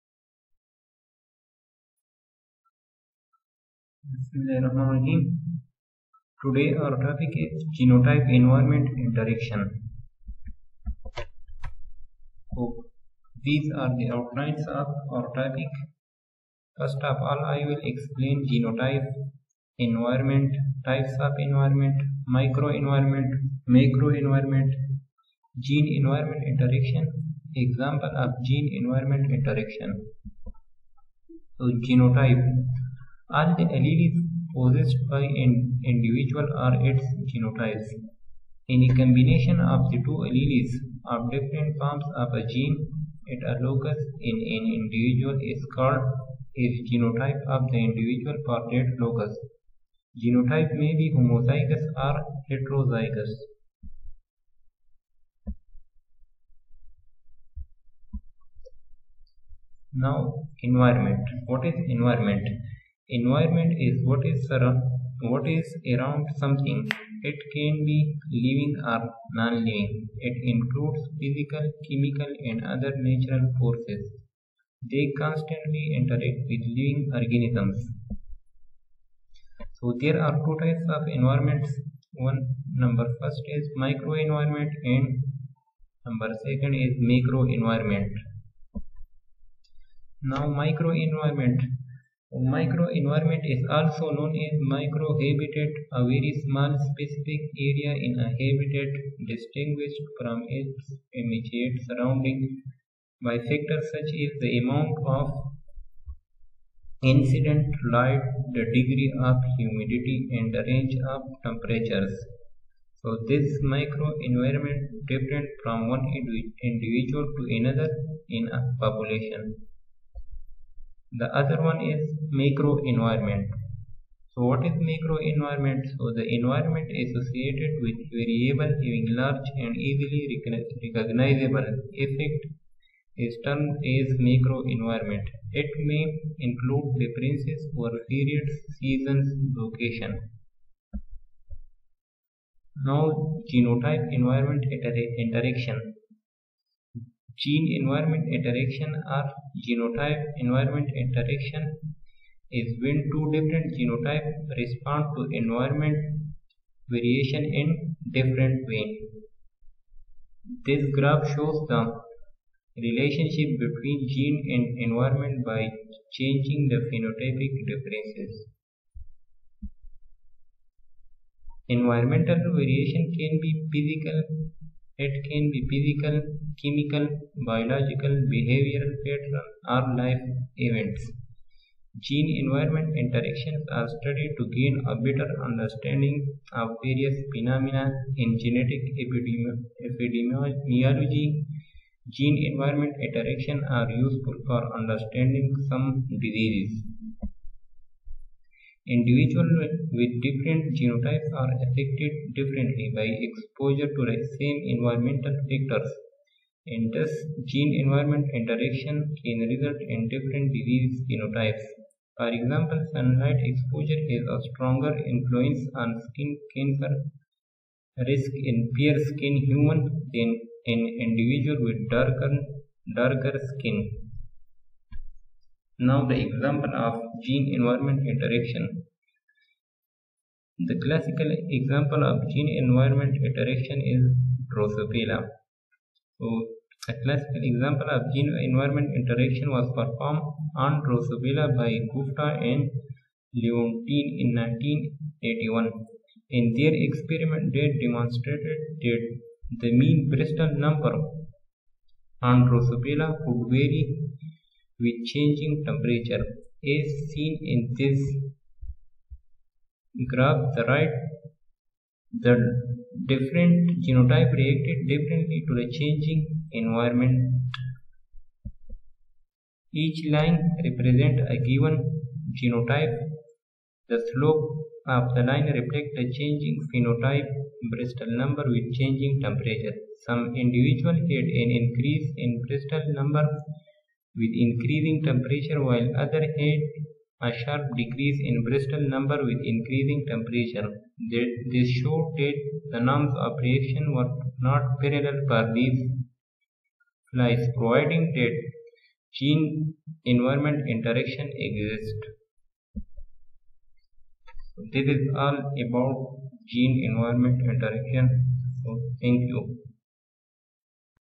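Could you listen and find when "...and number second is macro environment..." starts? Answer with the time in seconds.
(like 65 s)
84 s.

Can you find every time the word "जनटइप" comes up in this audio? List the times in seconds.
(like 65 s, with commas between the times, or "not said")
7 s, 18 s, 31 s.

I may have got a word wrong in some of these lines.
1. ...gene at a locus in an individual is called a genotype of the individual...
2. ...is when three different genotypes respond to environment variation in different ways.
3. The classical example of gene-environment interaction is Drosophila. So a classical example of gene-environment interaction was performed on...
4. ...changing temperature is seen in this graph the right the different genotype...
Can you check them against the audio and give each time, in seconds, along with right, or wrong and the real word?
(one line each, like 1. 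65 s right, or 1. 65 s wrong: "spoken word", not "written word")
1. 42 s right
2. 152 s wrong: "two", not "three"
3. 230 s right
4. 255 s right.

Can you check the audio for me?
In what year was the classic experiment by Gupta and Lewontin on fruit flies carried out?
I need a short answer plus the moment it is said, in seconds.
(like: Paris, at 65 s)
1981, at 244 s.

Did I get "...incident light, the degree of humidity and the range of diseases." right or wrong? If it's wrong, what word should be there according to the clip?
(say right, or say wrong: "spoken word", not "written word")
wrong: "temperatures", not "diseases".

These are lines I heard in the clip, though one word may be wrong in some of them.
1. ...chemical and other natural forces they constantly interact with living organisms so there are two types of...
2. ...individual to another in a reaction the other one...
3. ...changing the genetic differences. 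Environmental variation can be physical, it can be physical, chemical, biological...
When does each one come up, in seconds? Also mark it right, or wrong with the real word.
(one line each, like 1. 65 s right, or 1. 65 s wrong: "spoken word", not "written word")
1. 71 s right
2. 116 s wrong: "population", not "reaction"
3. 166 s wrong: "phenotypic", not "genetic".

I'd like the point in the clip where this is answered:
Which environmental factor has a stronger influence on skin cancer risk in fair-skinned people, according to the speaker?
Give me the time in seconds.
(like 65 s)
212 s.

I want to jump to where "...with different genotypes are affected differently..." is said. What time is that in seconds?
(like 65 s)
199 s.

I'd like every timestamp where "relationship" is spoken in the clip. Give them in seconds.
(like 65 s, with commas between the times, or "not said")
162 s.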